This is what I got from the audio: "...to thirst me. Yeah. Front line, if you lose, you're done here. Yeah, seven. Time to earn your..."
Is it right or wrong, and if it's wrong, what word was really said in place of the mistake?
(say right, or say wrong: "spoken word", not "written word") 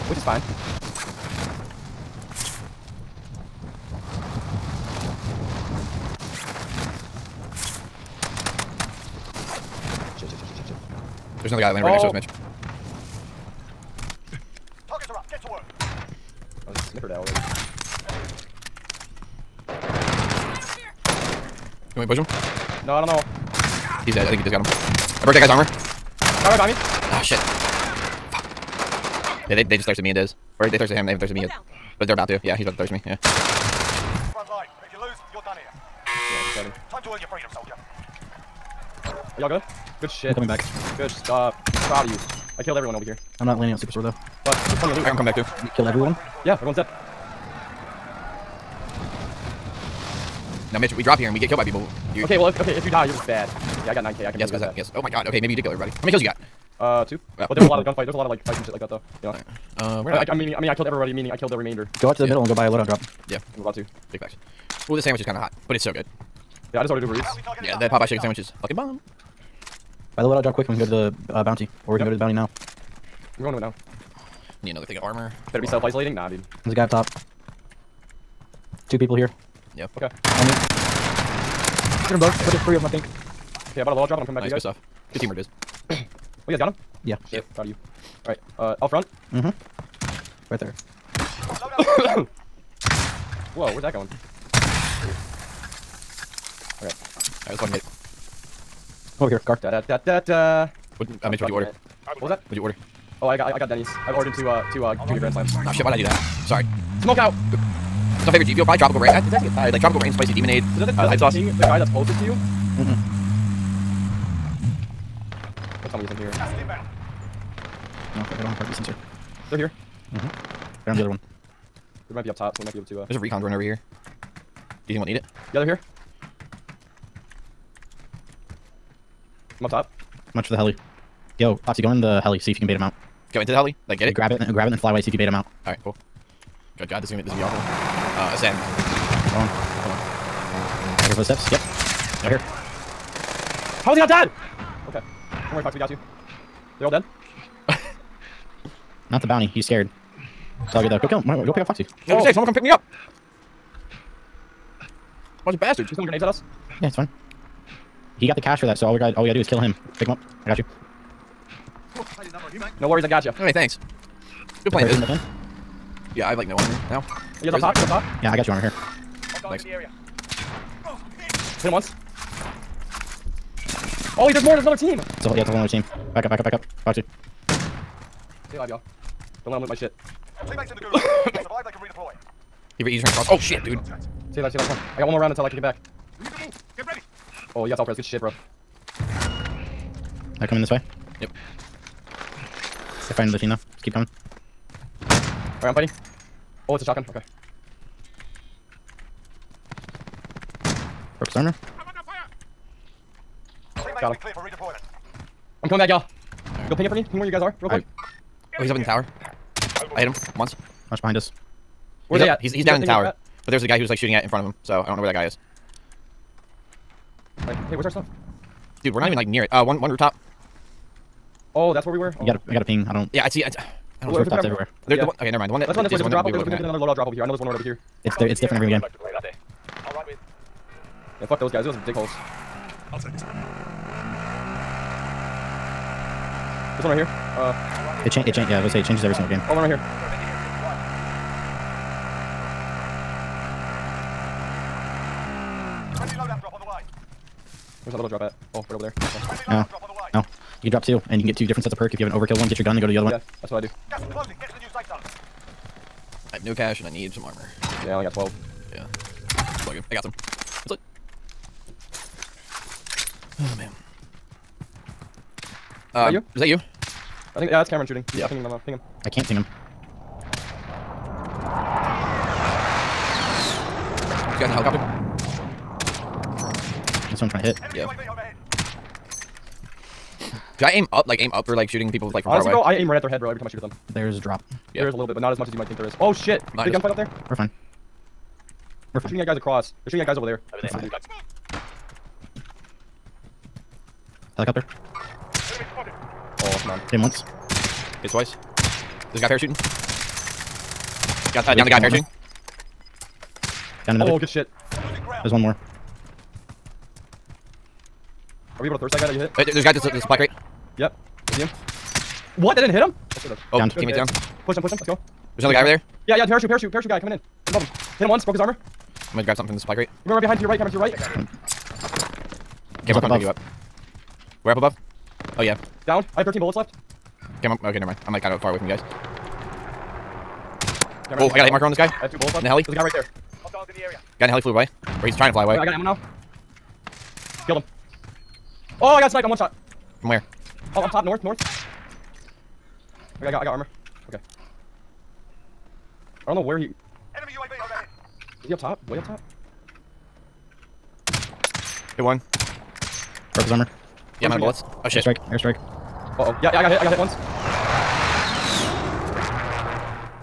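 right.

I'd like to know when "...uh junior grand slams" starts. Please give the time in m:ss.
1:44.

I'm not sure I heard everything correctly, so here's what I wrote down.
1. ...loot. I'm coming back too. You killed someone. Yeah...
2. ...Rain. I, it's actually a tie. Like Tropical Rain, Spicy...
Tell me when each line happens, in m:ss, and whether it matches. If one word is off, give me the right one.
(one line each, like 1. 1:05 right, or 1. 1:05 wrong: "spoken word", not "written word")
1. 0:44 wrong: "everyone", not "someone"
2. 1:48 right.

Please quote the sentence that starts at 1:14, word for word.
I need another thing of armor.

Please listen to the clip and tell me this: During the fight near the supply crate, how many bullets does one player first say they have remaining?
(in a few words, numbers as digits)
13.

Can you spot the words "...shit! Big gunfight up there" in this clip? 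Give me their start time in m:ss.
4:46.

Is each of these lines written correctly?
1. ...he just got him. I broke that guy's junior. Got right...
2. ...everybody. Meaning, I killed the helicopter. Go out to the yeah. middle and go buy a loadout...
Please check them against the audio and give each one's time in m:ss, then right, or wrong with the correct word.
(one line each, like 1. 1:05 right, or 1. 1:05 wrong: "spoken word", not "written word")
1. 0:24 wrong: "armor", not "junior"
2. 1:00 wrong: "remainder", not "helicopter".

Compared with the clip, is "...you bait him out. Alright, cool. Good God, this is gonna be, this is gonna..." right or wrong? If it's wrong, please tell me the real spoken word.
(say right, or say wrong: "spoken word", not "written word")
right.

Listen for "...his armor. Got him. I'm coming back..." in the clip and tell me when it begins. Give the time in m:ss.
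3:21.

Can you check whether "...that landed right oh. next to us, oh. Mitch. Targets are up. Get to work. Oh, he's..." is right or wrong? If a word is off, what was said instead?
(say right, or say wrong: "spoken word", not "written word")
right.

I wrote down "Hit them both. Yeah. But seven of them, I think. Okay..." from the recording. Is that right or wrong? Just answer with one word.
wrong.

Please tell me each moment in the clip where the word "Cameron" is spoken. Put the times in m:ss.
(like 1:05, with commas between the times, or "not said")
4:27, 5:20, 5:31.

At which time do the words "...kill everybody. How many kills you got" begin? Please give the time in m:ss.
0:55.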